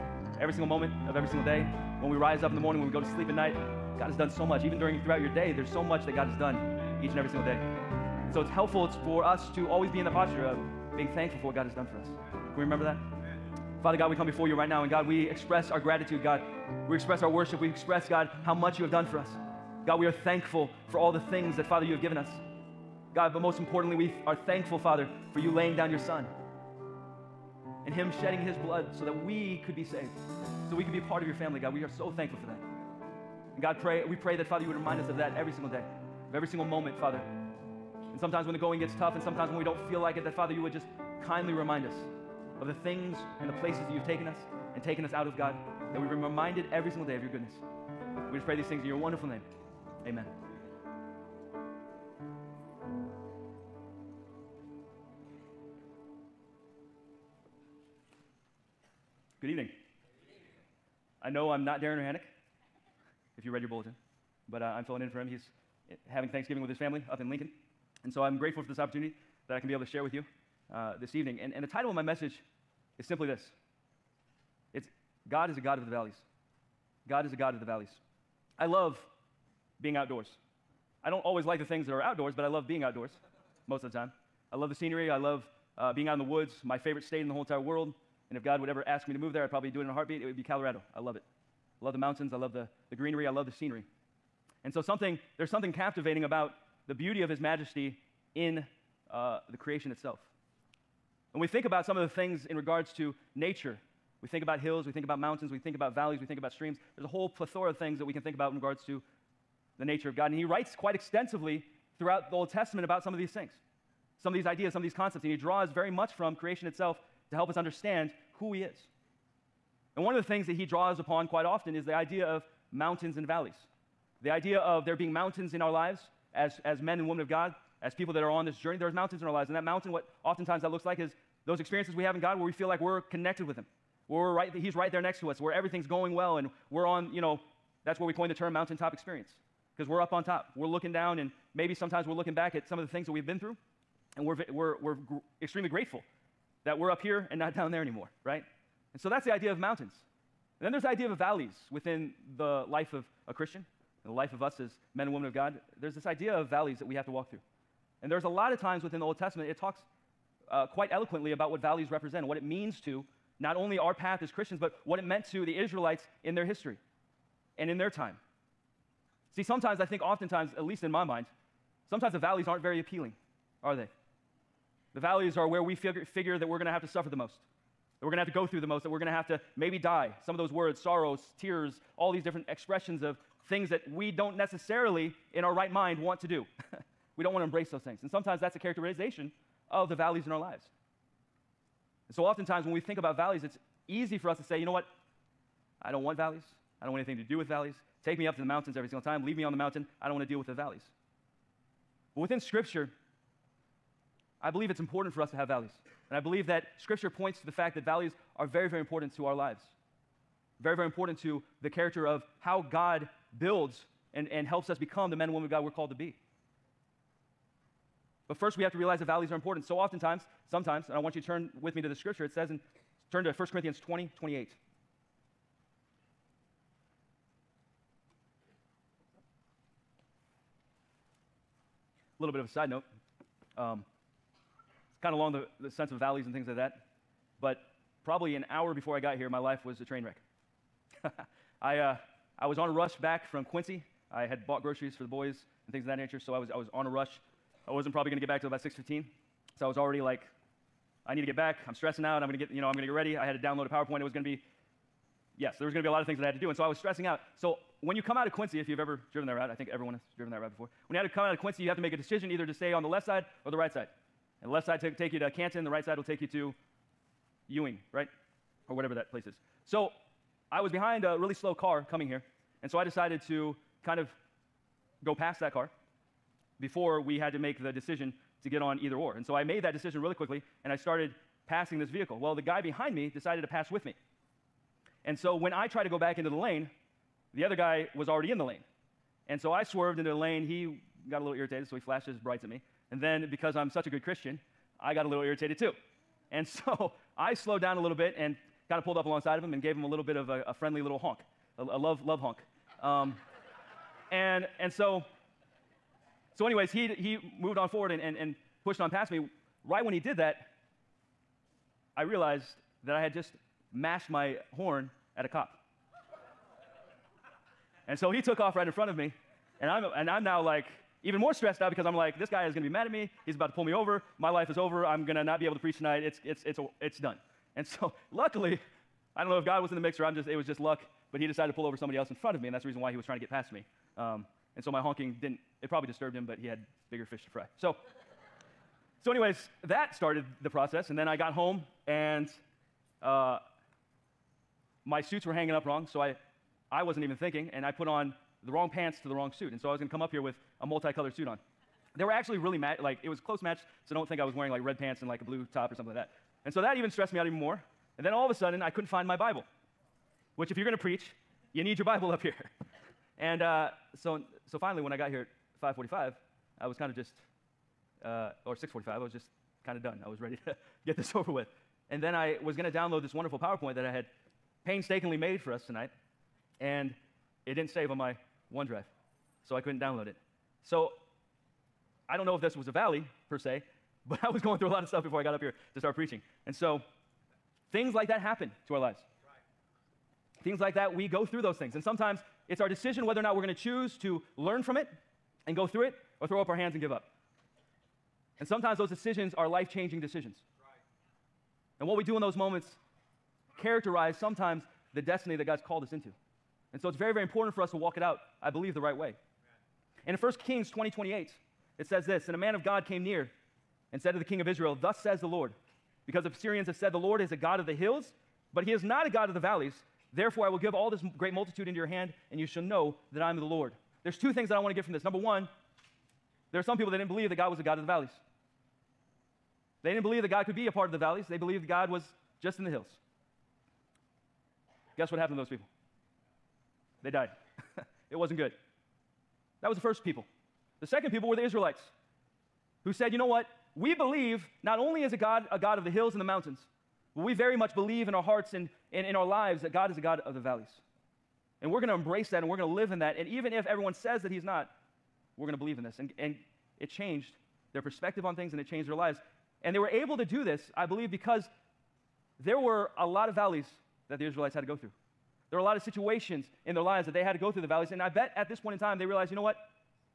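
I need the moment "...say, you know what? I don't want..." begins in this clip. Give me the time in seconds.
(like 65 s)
194 s.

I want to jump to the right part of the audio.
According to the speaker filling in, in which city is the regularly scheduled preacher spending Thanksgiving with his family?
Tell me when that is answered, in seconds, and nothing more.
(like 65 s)
67 s.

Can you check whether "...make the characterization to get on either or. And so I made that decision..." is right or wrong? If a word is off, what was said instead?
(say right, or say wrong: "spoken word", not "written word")
wrong: "decision", not "characterization".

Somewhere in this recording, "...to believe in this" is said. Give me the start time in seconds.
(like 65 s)
455 s.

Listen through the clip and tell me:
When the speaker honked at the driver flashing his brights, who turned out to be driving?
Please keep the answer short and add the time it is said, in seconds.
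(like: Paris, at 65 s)
A cop, at 315 s.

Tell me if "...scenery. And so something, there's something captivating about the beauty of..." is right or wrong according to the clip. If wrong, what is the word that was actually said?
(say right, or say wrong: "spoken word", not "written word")
right.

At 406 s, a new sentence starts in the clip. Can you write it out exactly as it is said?
And so it's very, very important for us to walk it out, I believe, the right way.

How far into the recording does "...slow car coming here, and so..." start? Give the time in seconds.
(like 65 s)
271 s.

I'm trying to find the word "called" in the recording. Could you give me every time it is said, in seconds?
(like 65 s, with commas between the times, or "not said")
215 s, 405 s.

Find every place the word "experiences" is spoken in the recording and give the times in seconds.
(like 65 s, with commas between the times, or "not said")
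131 s, 138 s.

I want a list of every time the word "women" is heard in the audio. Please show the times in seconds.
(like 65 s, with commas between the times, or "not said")
127 s, 155 s, 215 s.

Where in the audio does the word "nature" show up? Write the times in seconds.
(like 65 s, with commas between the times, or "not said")
103 s, 109 s, 245 s.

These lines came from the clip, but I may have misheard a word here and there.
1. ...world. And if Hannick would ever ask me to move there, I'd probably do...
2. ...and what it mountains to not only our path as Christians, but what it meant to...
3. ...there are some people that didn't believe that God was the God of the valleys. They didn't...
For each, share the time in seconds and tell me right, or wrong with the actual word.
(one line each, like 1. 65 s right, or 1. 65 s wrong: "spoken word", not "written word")
1. 87 s wrong: "God", not "Hannick"
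2. 162 s wrong: "means", not "mountains"
3. 426 s right.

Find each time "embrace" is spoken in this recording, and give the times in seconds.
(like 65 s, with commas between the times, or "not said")
187 s, 451 s.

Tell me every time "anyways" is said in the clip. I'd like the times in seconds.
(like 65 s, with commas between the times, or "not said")
306 s, 339 s.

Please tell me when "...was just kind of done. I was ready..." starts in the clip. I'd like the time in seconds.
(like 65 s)
369 s.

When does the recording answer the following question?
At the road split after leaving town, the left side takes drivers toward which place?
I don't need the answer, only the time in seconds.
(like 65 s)
265 s.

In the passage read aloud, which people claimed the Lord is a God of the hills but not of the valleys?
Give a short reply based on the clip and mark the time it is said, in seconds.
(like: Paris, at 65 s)
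The Syrians, at 416 s.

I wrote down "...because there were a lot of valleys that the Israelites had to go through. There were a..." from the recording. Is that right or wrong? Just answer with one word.
right.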